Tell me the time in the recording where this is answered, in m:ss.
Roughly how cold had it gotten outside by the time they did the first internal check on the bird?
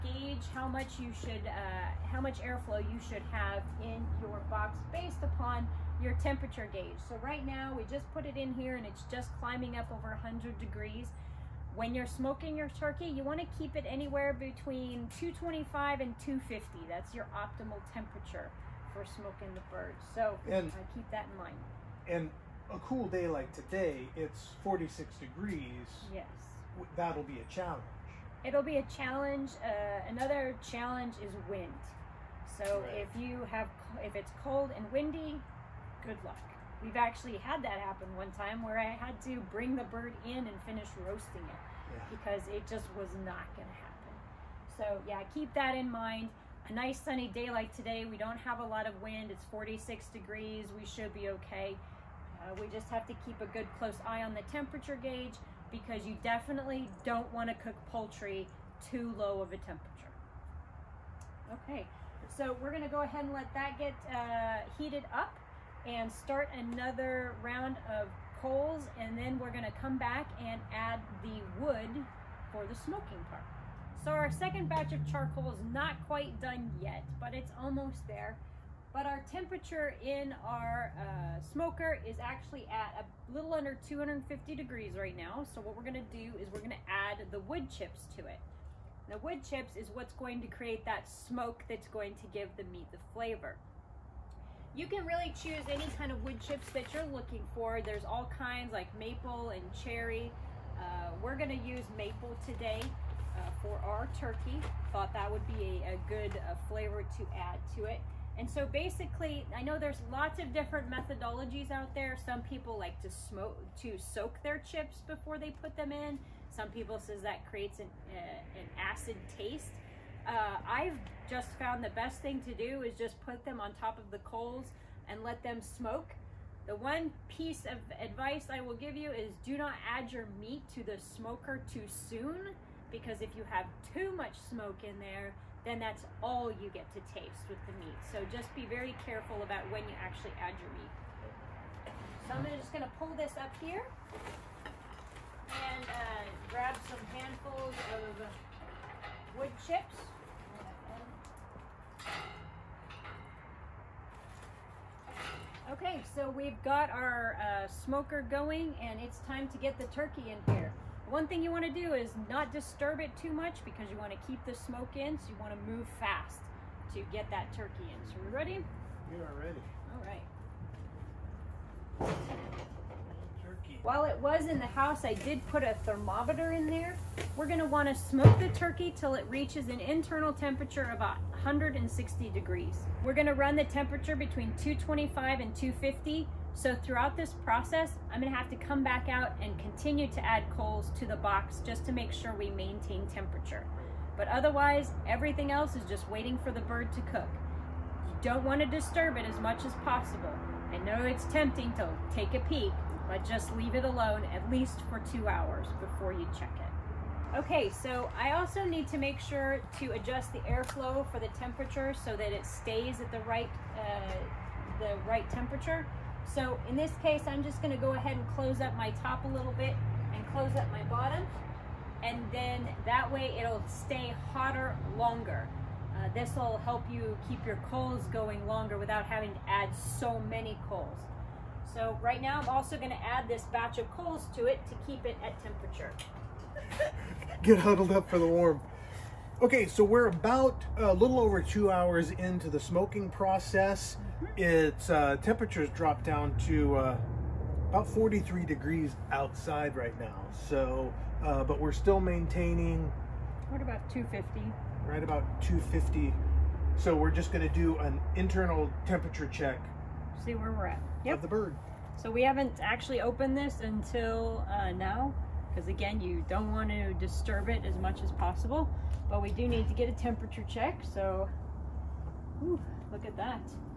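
4:07.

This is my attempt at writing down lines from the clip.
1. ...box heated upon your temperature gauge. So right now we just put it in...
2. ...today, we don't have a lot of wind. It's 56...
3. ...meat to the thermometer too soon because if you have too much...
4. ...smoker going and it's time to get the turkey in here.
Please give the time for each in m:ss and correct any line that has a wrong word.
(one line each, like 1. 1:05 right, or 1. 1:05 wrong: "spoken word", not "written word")
1. 0:04 wrong: "based", not "heated"
2. 0:47 wrong: "46", not "56"
3. 2:10 wrong: "smoker", not "thermometer"
4. 2:37 right.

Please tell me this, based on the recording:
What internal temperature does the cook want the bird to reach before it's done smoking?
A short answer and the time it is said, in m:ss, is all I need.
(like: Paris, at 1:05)
160 degrees, at 3:00.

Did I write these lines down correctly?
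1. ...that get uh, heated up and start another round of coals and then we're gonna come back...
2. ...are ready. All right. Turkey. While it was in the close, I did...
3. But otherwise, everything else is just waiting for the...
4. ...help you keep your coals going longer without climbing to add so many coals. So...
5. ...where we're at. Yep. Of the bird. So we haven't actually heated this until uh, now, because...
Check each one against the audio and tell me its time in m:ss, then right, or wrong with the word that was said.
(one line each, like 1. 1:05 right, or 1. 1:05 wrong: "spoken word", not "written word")
1. 1:03 right
2. 2:49 wrong: "house", not "close"
3. 3:14 right
4. 3:46 wrong: "having", not "climbing"
5. 4:20 wrong: "opened", not "heated".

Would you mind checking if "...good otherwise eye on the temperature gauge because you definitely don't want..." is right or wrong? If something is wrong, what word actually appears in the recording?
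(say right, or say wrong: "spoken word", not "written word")
wrong: "close", not "otherwise".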